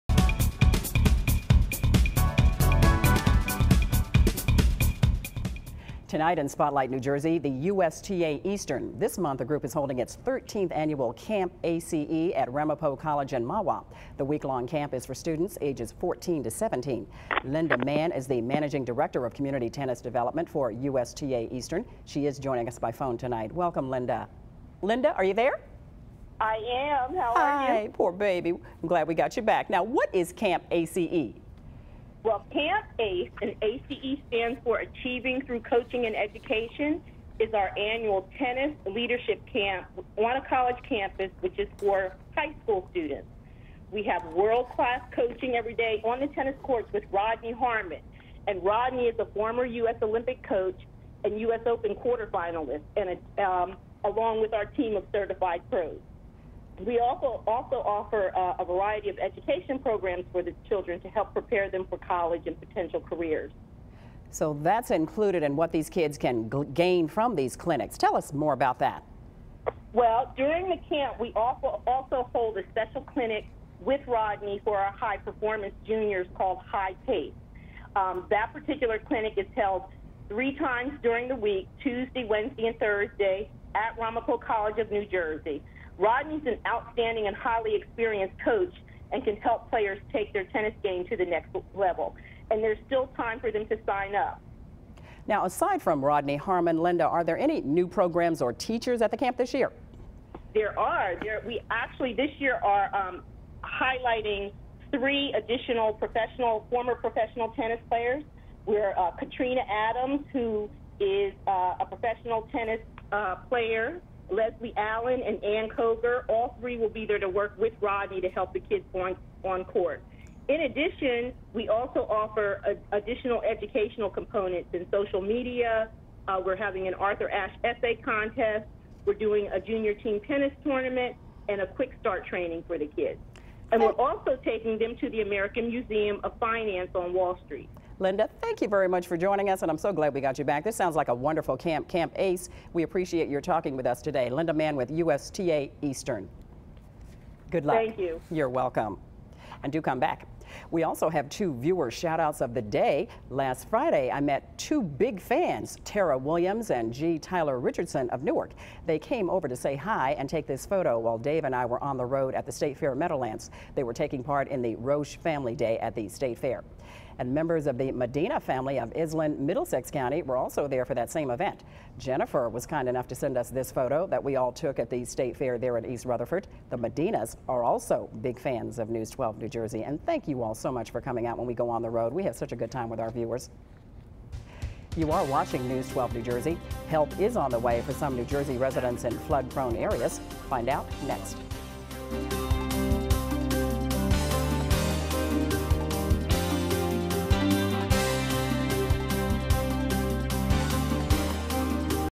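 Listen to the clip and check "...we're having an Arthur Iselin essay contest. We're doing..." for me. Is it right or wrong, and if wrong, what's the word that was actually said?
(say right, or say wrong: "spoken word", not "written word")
wrong: "Ashe", not "Iselin".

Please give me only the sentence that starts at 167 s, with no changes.
And members of the Medina family of Iselin, Middlesex County were also there for that same event.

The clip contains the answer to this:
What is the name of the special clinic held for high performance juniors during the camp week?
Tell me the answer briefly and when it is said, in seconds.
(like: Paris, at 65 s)
High Pace, at 76 s.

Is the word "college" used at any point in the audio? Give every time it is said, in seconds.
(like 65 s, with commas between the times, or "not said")
12 s, 40 s, 61 s, 84 s.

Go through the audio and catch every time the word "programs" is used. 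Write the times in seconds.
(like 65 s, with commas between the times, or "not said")
59 s, 97 s.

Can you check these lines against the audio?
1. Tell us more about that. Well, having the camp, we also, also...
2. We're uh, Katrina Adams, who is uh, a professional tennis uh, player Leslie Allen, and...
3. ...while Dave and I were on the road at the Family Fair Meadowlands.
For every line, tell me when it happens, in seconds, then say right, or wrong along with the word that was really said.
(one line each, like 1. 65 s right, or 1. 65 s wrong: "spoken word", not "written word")
1. 67 s wrong: "during", not "having"
2. 108 s right
3. 160 s wrong: "State", not "Family".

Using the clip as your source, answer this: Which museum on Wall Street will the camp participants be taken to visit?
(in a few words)
American Museum of Finance.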